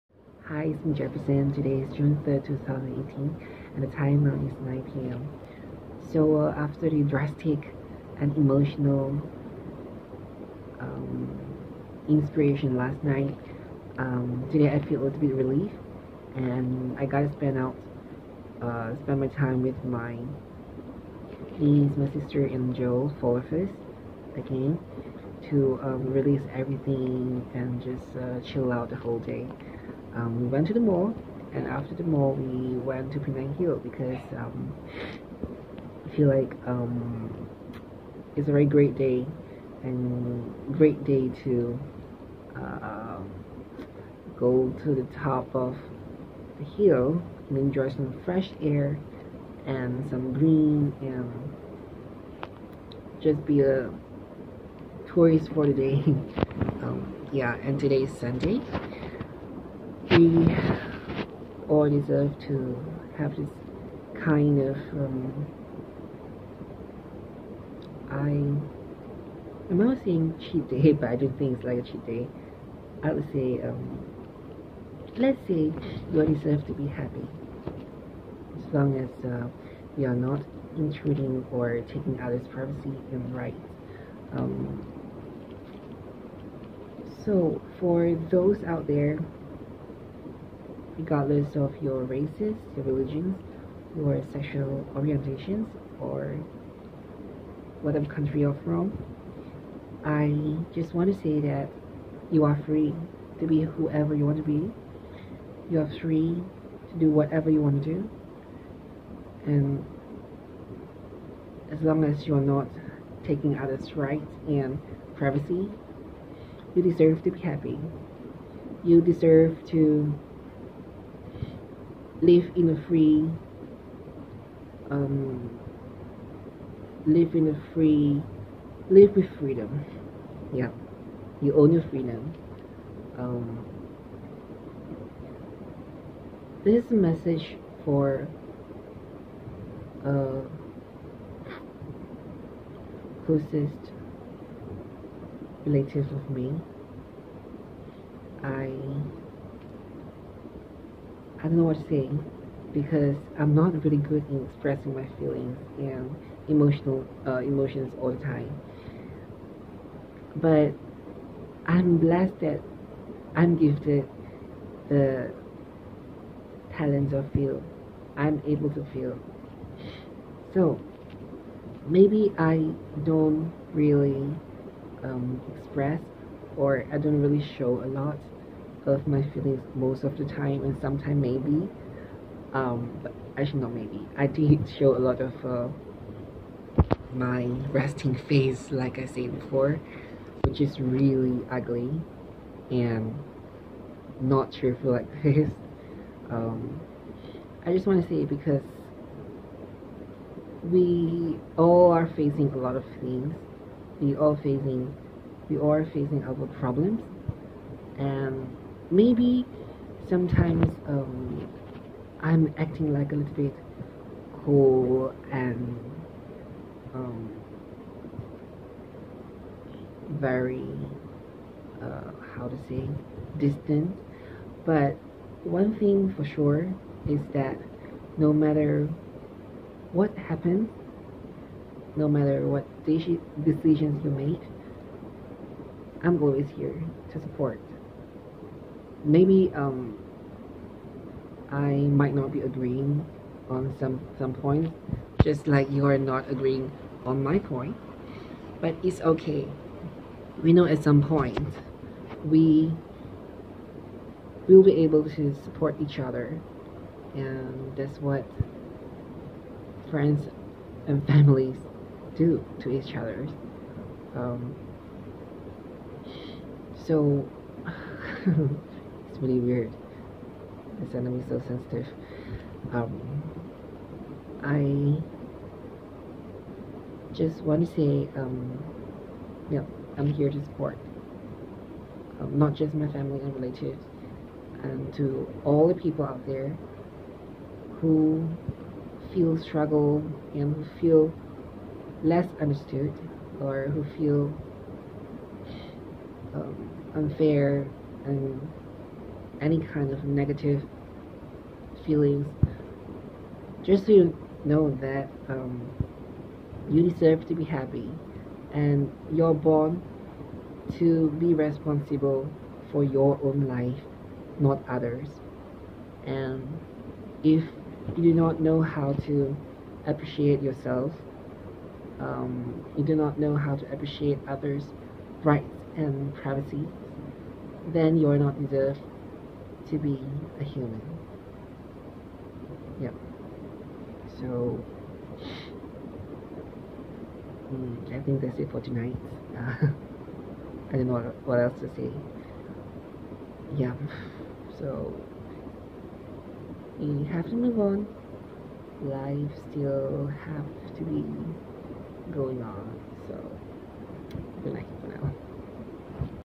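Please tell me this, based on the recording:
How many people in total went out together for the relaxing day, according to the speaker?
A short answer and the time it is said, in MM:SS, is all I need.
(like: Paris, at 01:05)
4, at 00:23.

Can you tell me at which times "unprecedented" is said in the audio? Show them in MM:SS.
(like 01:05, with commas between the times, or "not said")
not said.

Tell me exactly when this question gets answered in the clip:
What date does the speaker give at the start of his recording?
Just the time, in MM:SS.
00:01.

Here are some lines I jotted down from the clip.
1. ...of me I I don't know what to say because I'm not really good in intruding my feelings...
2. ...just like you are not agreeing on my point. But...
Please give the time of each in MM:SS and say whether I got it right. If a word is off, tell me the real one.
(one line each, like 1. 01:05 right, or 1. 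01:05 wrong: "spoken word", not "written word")
1. 02:26 wrong: "expressing", not "intruding"
2. 04:05 right.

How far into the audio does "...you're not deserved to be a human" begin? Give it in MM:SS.
05:27.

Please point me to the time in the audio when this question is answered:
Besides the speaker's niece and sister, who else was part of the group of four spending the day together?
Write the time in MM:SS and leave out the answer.
00:22.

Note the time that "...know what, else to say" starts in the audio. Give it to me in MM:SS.
05:40.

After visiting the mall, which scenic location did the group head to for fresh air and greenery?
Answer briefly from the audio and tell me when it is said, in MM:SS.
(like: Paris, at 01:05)
Penang Hill, at 00:33.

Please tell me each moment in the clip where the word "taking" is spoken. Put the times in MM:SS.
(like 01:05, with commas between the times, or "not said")
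01:21, 01:53.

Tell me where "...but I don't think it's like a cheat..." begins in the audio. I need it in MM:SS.
01:10.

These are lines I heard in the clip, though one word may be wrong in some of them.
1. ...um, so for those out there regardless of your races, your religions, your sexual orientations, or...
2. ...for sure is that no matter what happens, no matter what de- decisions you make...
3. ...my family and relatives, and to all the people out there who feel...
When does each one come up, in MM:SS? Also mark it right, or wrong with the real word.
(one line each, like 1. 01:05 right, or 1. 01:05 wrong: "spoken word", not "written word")
1. 01:24 right
2. 03:46 right
3. 04:42 right.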